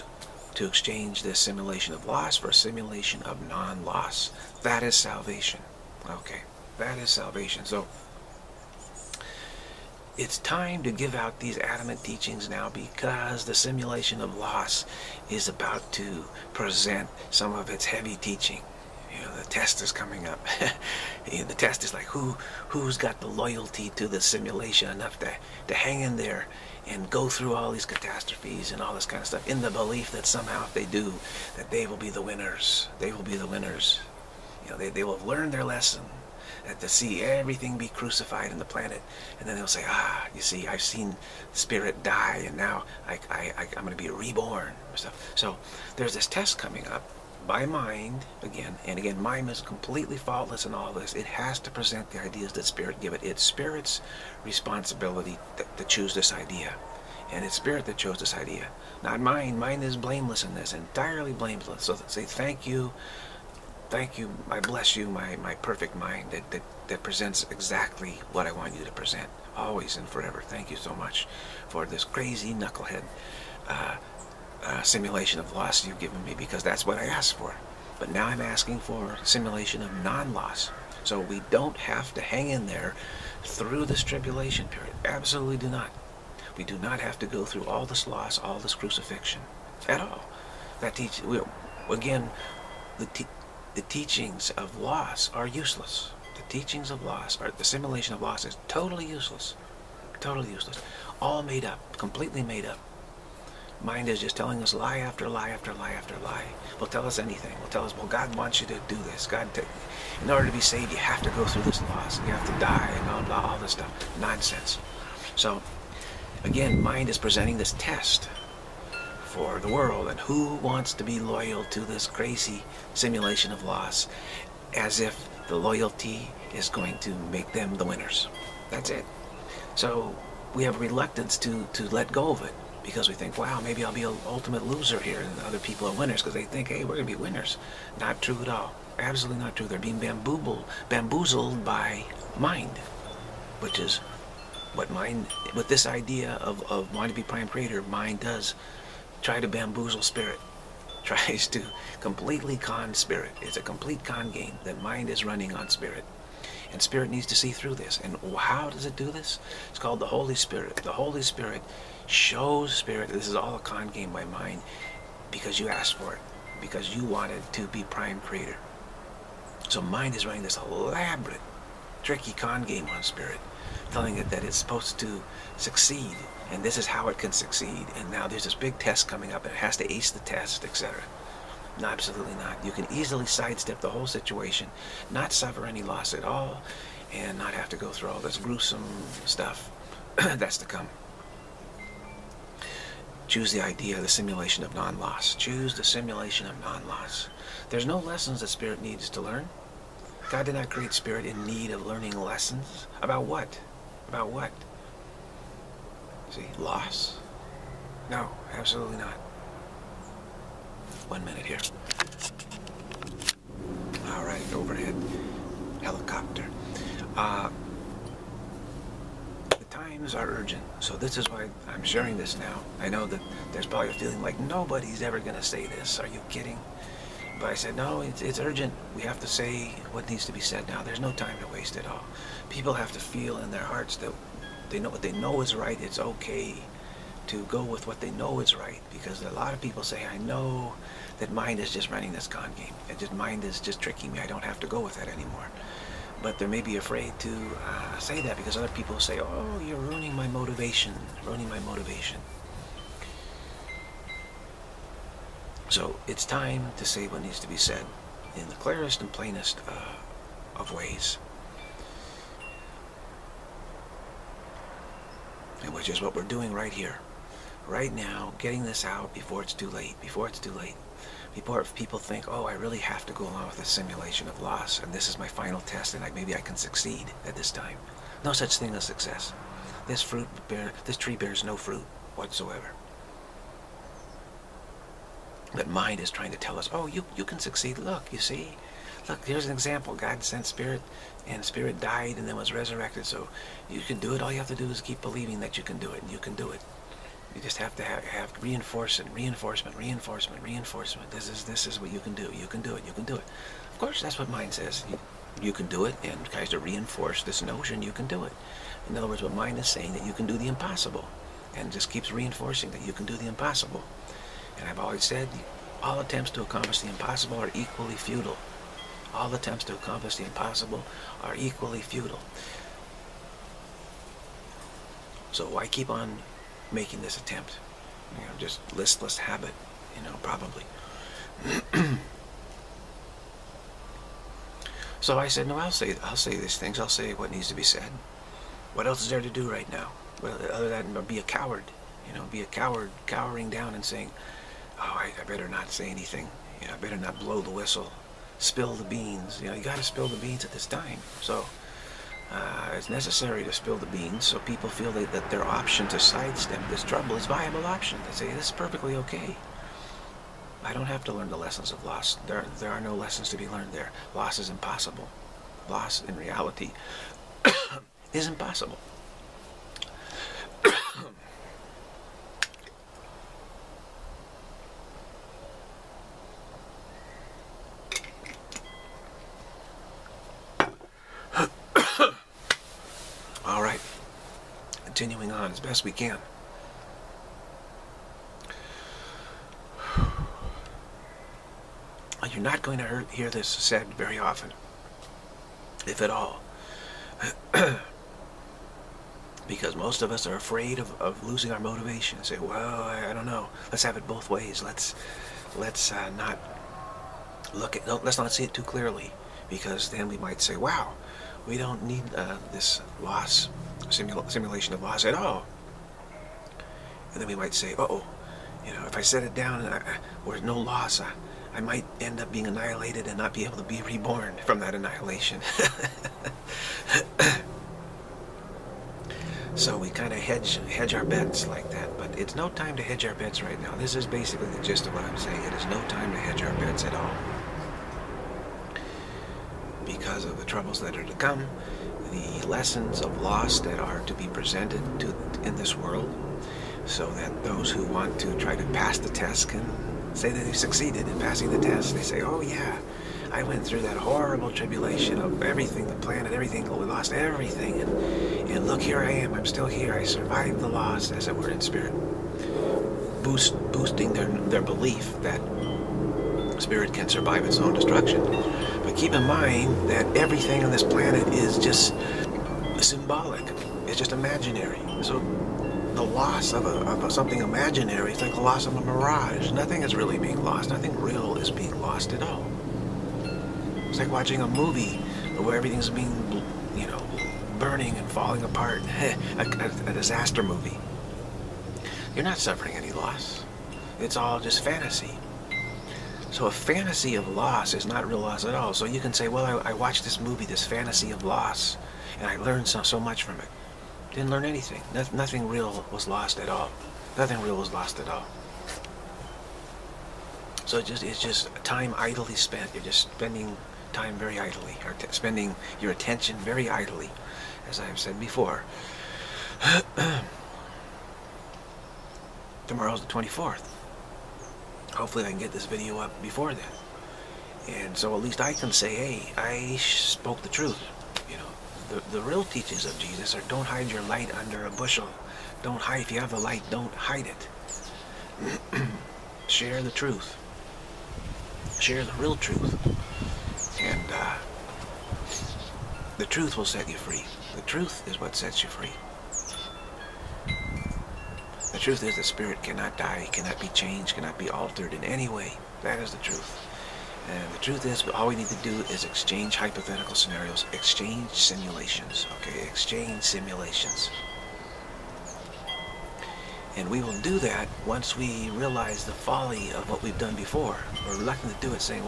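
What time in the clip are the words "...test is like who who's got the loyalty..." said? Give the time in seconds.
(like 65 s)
21 s.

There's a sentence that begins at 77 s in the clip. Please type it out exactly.
But now I'm asking for simulation of non-loss.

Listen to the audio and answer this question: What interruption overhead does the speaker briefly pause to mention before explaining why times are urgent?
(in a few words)
helicopter.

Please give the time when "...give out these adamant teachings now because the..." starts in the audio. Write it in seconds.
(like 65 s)
10 s.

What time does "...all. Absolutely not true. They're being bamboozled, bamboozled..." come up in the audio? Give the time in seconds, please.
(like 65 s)
138 s.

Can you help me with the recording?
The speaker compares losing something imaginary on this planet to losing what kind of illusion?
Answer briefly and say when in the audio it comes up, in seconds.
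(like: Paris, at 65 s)
a mirage, at 478 s.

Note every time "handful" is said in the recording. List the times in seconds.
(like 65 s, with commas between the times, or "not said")
not said.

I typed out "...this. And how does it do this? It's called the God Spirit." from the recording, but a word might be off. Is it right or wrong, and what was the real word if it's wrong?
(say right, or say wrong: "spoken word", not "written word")
wrong: "Holy", not "God".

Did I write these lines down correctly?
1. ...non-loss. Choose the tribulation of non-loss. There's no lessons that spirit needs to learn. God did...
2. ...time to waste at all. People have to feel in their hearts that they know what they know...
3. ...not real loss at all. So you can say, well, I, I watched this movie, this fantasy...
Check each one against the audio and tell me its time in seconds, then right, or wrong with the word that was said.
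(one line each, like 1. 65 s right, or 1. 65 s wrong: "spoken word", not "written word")
1. 194 s wrong: "simulation", not "tribulation"
2. 231 s right
3. 497 s right.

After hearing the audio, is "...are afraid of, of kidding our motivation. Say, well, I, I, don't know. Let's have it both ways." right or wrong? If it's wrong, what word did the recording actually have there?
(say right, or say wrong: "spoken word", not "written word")
wrong: "losing", not "kidding".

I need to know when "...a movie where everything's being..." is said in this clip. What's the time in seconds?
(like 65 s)
484 s.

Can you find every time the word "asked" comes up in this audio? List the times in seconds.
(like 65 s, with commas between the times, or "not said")
77 s, 165 s.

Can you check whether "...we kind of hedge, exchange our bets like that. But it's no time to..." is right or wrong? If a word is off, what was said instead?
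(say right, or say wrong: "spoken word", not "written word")
wrong: "hedge", not "exchange".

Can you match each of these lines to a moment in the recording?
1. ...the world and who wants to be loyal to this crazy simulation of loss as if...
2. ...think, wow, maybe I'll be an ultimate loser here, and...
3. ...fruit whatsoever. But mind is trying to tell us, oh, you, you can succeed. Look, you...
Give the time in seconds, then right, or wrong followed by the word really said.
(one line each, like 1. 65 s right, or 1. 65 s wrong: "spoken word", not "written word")
1. 119 s right
2. 133 s right
3. 281 s right.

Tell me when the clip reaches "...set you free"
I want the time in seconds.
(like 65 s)
546 s.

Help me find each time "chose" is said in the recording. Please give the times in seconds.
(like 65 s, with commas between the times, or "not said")
57 s.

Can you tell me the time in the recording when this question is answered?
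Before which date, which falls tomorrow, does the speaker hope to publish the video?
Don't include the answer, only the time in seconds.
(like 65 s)
523 s.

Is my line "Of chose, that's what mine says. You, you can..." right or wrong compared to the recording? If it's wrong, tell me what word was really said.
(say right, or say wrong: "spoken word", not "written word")
wrong: "course", not "chose".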